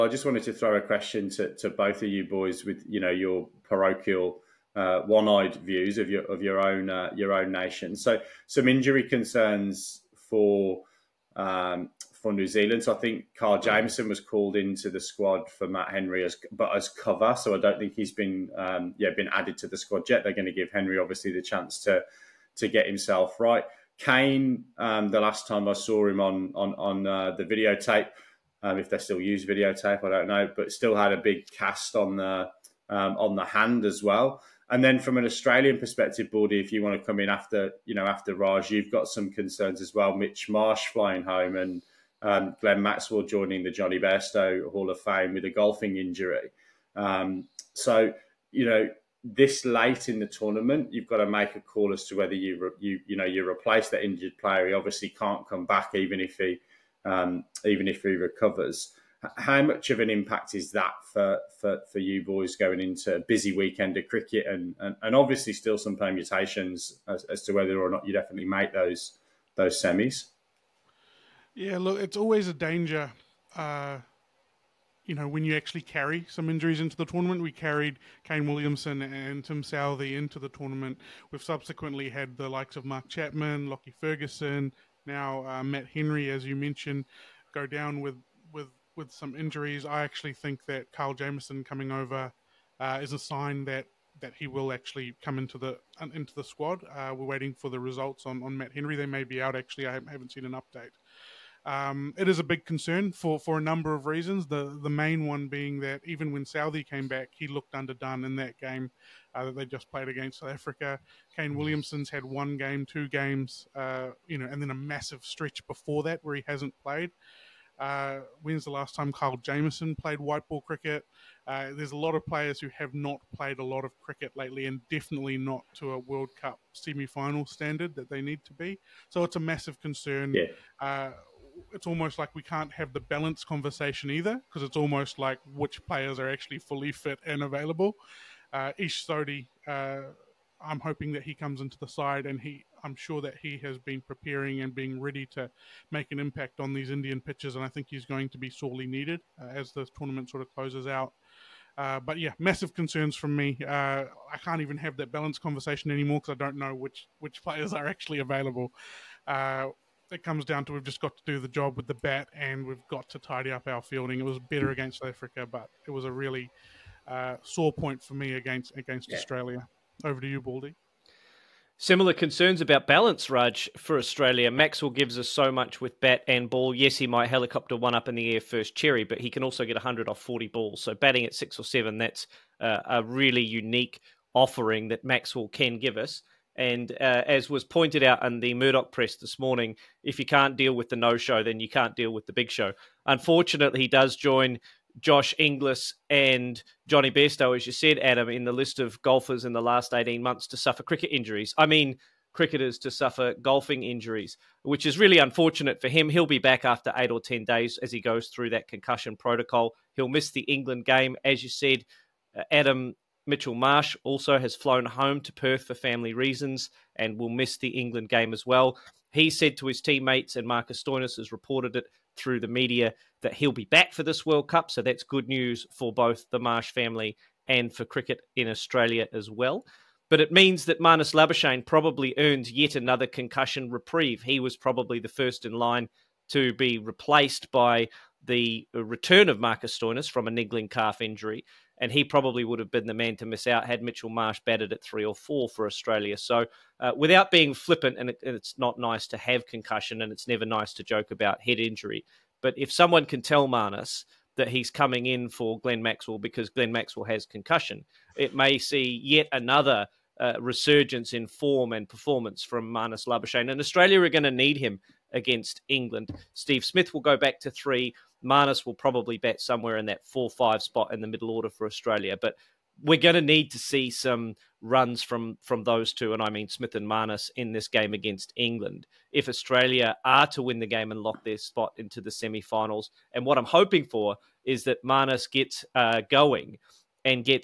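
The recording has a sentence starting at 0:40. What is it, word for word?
Mitch Marsh flying home and um, Glenn Maxwell joining the Jonny Bairstow Hall of Fame with a golfing injury.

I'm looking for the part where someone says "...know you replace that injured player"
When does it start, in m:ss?
0:53.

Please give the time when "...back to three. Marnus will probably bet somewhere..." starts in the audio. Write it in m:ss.
4:27.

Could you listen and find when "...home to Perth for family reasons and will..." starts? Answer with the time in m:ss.
3:34.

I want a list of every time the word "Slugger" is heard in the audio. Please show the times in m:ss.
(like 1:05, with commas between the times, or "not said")
not said.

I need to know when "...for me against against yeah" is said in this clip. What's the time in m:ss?
2:48.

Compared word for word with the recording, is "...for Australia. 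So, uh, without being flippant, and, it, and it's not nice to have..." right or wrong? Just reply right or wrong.
right.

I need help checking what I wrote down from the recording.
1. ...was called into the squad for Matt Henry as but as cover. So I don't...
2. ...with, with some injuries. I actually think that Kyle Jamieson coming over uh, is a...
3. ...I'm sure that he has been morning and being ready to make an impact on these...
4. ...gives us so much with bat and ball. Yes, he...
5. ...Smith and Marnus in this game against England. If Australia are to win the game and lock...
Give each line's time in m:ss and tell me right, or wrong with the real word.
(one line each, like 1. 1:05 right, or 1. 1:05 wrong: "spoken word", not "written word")
1. 0:14 right
2. 1:28 right
3. 2:22 wrong: "preparing", not "morning"
4. 2:54 right
5. 4:36 right.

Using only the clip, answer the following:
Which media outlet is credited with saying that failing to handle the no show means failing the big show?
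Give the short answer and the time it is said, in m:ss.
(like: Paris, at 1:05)
Murdoch press, at 3:08.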